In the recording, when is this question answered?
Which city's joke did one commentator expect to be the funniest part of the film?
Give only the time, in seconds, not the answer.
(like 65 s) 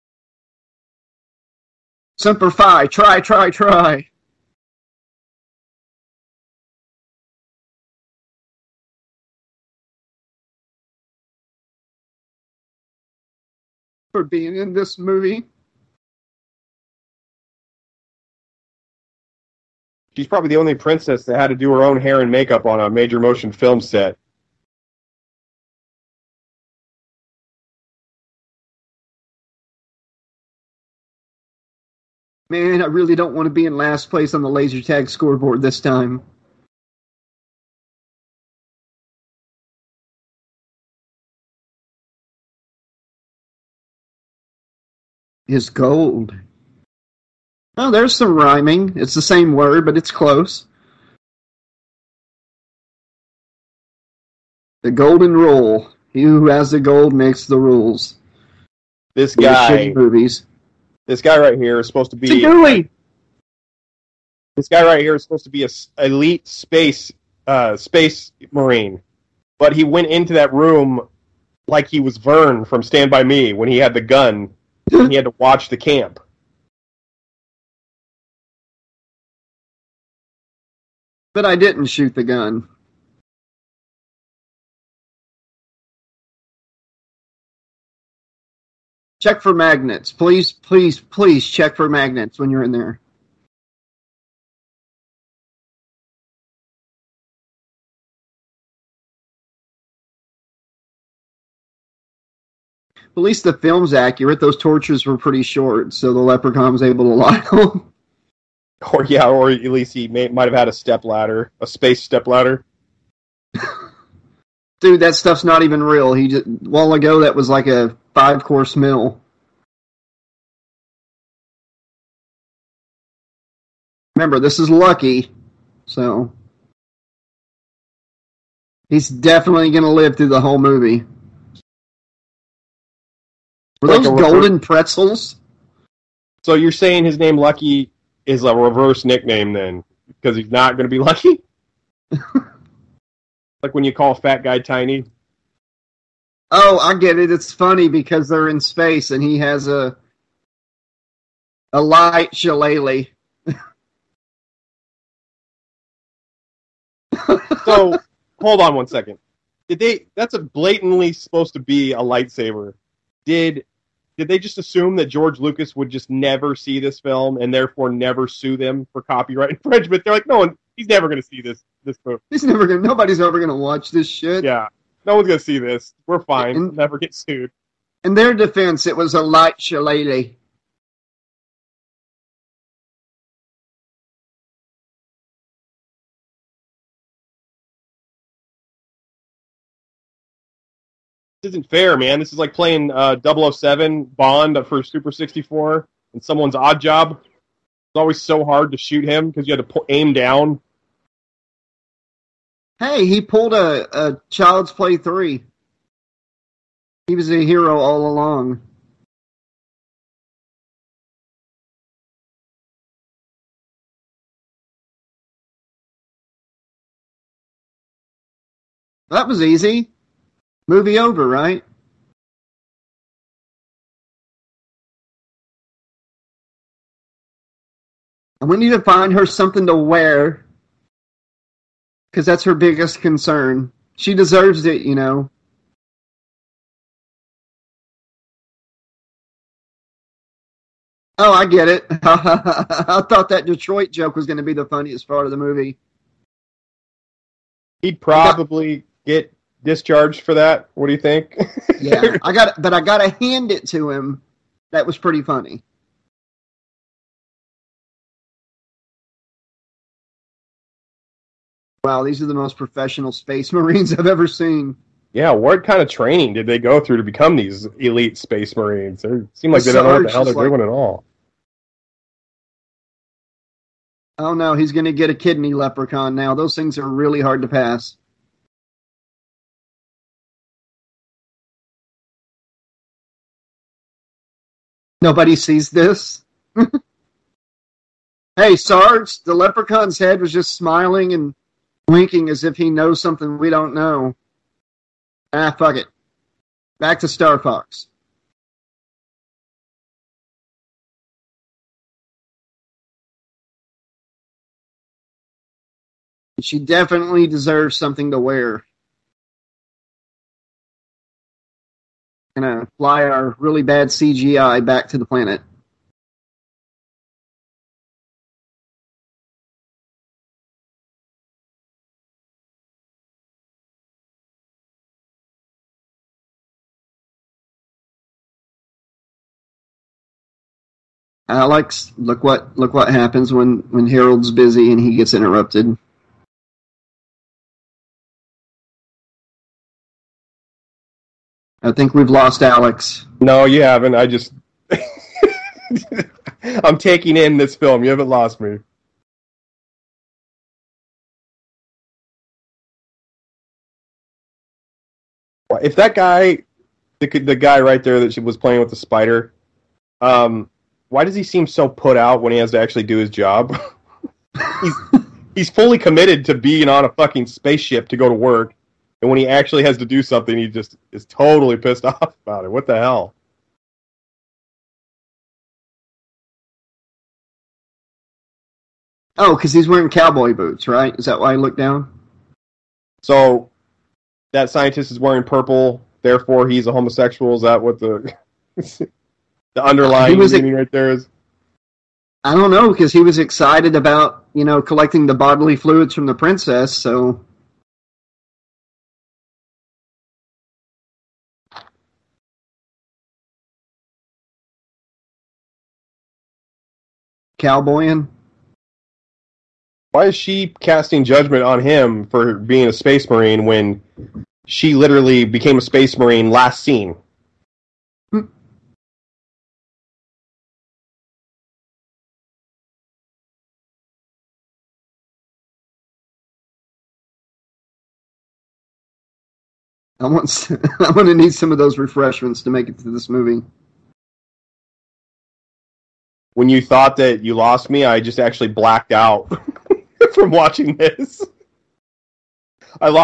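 243 s.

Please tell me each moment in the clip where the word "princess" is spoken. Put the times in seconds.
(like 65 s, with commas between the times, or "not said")
20 s, 396 s.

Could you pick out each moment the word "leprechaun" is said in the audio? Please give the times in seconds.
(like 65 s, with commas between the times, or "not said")
106 s, 275 s, 289 s.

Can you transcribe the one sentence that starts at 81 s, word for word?
But I didn't shoot the gun.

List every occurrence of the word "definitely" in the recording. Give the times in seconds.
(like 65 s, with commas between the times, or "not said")
129 s, 306 s.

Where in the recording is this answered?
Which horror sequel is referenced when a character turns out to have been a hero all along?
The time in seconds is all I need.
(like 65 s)
204 s.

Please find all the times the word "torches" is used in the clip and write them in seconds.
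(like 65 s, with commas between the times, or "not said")
104 s.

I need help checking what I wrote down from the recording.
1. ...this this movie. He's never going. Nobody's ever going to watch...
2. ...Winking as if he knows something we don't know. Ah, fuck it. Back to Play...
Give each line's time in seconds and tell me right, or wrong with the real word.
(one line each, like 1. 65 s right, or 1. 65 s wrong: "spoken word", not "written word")
1. 171 s right
2. 291 s wrong: "Star", not "Play".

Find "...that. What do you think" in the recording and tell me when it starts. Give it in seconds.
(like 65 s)
250 s.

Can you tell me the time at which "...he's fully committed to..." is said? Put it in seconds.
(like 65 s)
365 s.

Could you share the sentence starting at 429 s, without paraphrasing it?
I want I'm going to need some of those refreshments to make it to this movie.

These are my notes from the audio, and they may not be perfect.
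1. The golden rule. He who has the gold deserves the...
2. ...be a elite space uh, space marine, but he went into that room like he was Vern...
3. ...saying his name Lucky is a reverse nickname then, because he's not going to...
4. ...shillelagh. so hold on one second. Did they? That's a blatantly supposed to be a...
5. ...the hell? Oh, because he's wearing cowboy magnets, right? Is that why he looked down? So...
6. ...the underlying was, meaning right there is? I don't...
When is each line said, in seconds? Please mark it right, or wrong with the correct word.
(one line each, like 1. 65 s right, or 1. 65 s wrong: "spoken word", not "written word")
1. 54 s wrong: "makes", not "deserves"
2. 65 s right
3. 136 s right
4. 152 s right
5. 372 s wrong: "boots", not "magnets"
6. 389 s right.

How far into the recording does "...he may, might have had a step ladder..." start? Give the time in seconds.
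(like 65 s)
109 s.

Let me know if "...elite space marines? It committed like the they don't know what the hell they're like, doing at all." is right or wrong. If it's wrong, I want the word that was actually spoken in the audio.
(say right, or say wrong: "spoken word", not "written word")
wrong: "seemed", not "committed".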